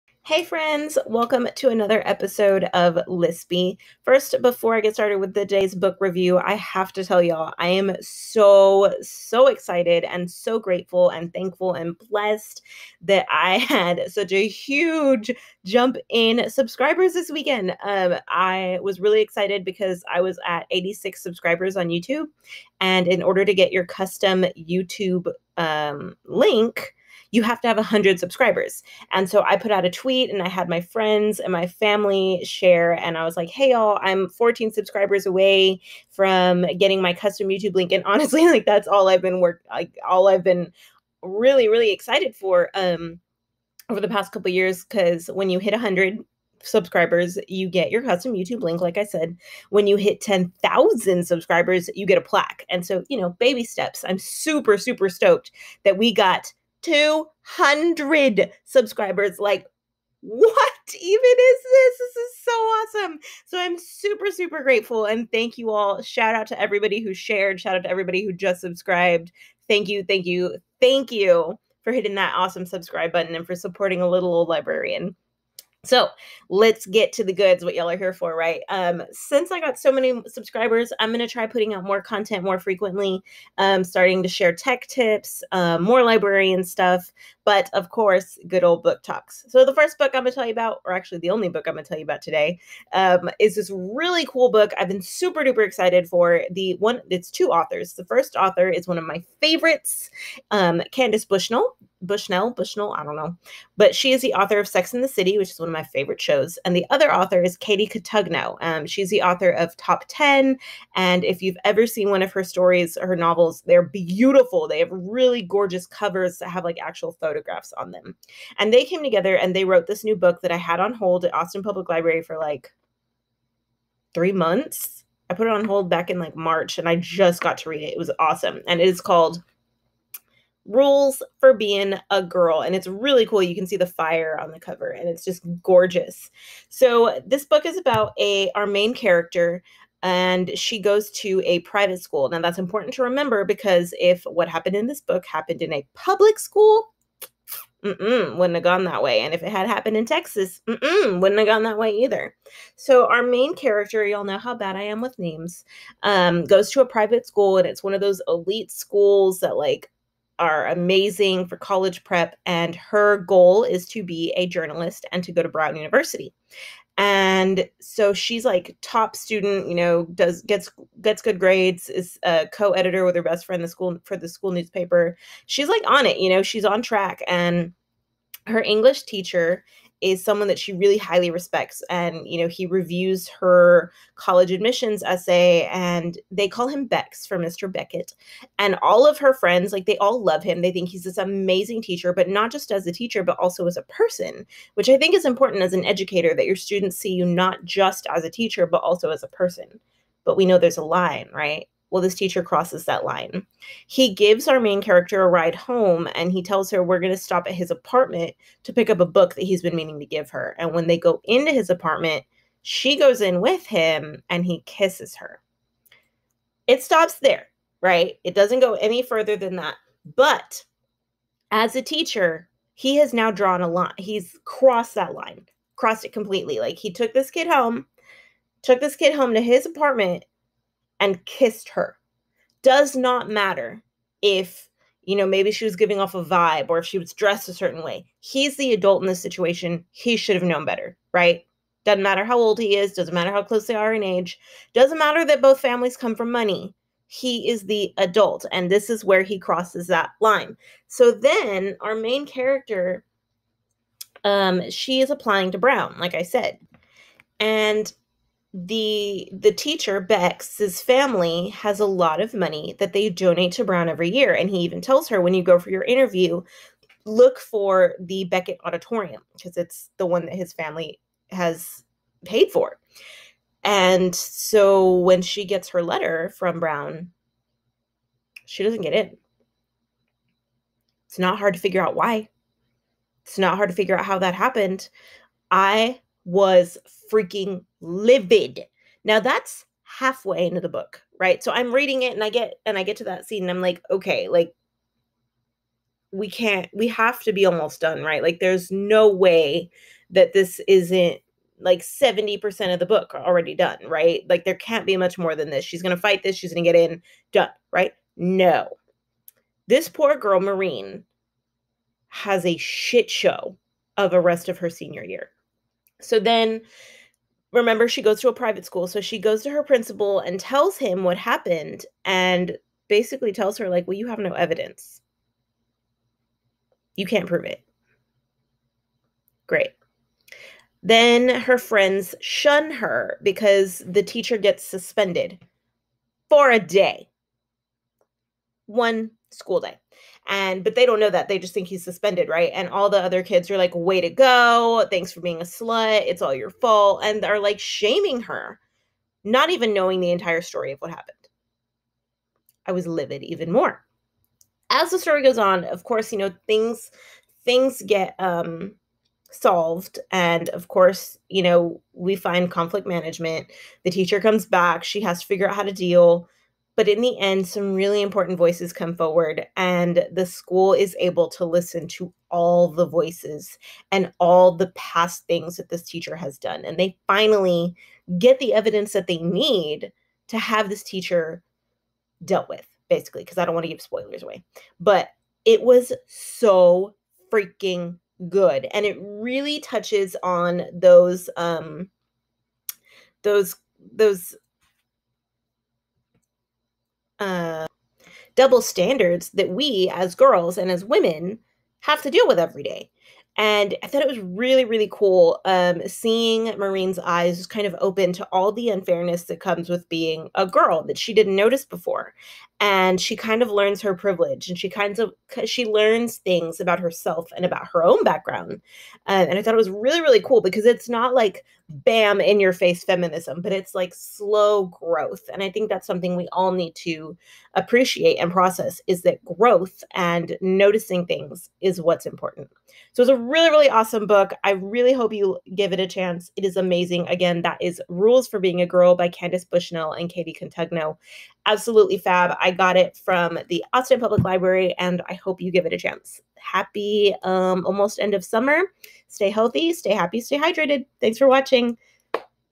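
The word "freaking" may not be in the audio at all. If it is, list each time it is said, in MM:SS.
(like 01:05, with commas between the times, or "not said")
04:47, 06:27.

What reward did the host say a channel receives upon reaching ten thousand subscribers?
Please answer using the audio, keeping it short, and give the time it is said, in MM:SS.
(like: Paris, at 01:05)
A plaque, at 00:52.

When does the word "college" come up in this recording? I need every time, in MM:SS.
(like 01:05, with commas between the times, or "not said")
02:41, 03:04.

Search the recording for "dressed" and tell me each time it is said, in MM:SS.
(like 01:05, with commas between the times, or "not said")
03:57.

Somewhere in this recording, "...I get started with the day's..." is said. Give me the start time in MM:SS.
00:04.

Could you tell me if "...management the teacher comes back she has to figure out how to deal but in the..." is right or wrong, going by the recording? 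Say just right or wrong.
right.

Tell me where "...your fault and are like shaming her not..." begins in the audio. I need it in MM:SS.
05:46.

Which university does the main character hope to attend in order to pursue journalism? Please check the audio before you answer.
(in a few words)
Brown University.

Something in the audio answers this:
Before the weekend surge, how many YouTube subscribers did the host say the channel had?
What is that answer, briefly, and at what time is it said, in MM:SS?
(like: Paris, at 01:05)
86, at 00:20.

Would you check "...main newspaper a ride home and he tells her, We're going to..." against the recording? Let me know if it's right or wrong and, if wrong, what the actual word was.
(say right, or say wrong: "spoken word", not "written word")
wrong: "character", not "newspaper".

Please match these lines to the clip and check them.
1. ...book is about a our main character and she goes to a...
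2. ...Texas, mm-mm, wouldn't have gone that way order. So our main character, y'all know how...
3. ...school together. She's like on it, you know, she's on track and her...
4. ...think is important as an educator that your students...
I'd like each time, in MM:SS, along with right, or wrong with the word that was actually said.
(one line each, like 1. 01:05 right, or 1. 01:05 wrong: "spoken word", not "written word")
1. 02:17 right
2. 02:30 wrong: "either", not "order"
3. 02:54 wrong: "newspaper", not "together"
4. 03:14 right.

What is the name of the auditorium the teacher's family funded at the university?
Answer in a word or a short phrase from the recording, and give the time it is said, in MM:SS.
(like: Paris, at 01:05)
Beckett auditorium, at 04:28.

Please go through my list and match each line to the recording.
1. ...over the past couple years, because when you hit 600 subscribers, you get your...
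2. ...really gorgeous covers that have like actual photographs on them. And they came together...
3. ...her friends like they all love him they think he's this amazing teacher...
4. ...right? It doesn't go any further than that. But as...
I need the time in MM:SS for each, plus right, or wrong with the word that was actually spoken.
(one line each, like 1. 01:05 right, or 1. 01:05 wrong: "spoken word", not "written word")
1. 00:43 wrong: "100", not "600"
2. 01:54 right
3. 03:09 right
4. 03:37 right.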